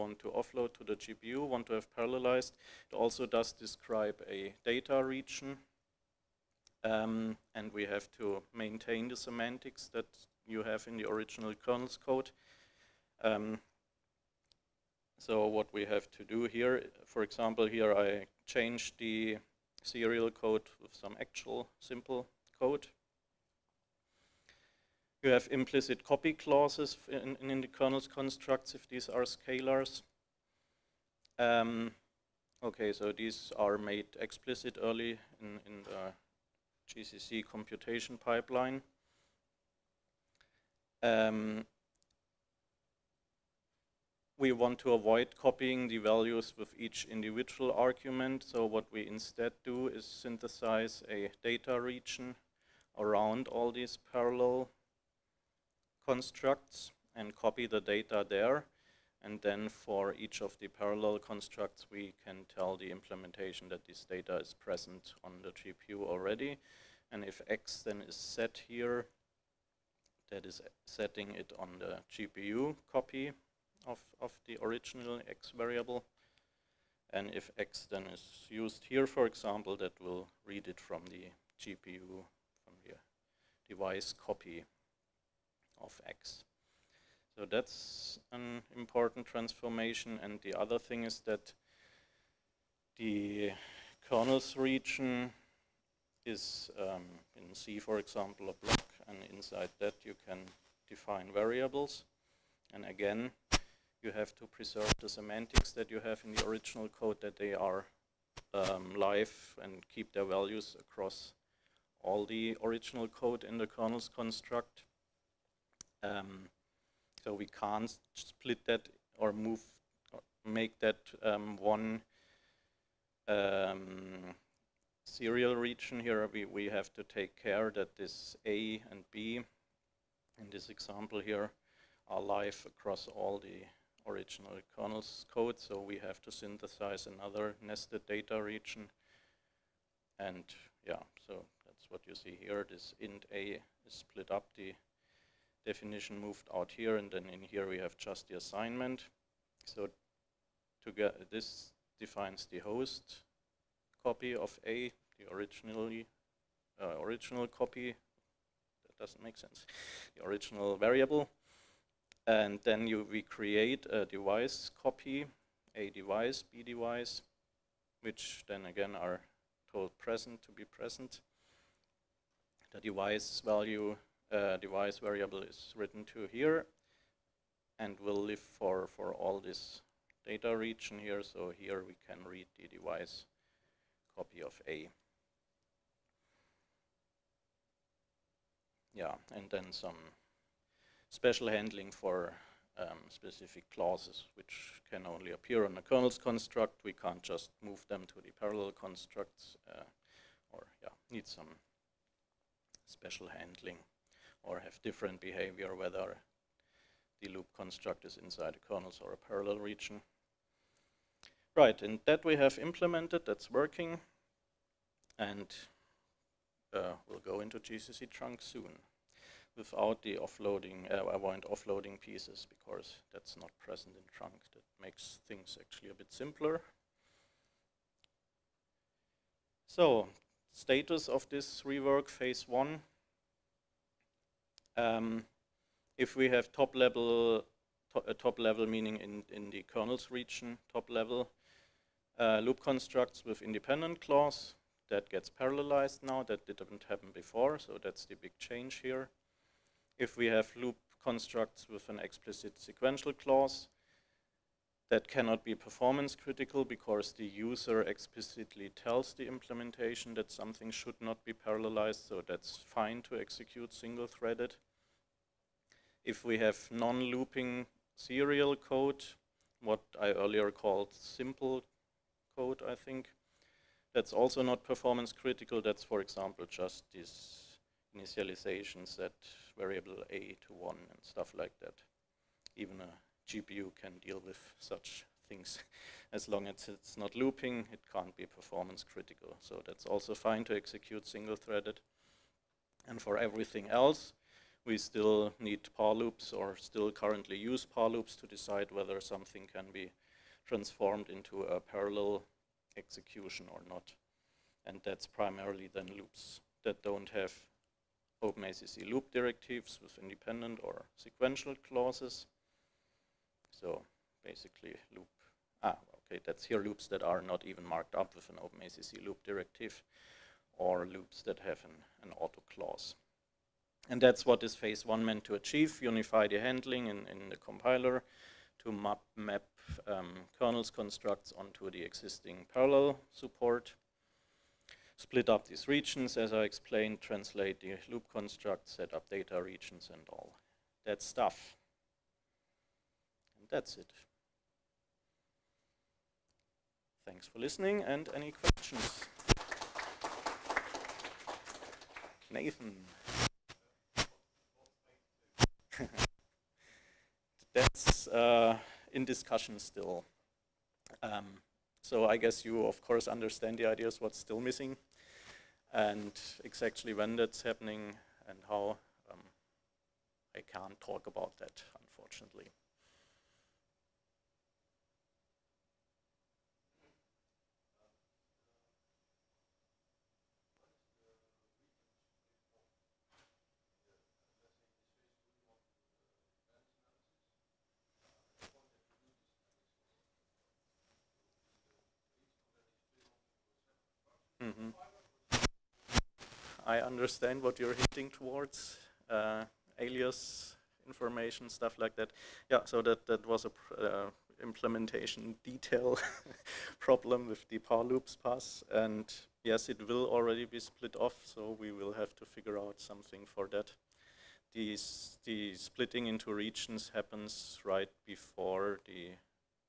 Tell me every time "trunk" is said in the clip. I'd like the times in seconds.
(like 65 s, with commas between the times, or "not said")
218 s, 224 s.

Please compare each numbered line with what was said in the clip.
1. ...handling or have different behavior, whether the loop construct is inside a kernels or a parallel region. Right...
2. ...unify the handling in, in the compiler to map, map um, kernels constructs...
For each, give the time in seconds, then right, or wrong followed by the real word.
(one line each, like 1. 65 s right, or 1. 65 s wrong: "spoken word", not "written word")
1. 203 s right
2. 325 s right.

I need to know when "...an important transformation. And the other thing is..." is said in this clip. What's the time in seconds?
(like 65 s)
88 s.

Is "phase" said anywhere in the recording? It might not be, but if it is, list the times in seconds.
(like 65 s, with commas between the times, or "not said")
232 s, 324 s.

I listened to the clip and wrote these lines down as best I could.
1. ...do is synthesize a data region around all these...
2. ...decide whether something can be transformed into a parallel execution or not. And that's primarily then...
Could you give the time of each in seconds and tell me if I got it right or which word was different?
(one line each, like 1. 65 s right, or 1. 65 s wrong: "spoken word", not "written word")
1. 49 s right
2. 298 s right.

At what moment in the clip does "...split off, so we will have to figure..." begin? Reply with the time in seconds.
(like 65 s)
410 s.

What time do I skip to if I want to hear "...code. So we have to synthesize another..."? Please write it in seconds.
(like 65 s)
135 s.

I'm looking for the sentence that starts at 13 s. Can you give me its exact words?
Um, so what we have to do here, for example, here I change the serial code with some actual simple code.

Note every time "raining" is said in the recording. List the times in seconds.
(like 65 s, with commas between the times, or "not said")
not said.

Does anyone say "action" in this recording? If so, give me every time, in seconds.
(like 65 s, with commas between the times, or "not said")
not said.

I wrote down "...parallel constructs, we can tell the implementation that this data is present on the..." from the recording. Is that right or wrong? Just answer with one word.
right.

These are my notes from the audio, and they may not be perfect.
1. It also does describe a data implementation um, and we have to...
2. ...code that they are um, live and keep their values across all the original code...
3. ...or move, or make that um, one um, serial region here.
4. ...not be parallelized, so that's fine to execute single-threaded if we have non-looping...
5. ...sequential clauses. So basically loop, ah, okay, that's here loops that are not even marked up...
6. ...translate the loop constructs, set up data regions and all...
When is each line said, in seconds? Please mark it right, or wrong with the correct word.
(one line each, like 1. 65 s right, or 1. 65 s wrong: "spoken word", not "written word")
1. 2 s wrong: "region", not "implementation"
2. 106 s right
3. 119 s right
4. 261 s right
5. 310 s right
6. 337 s right.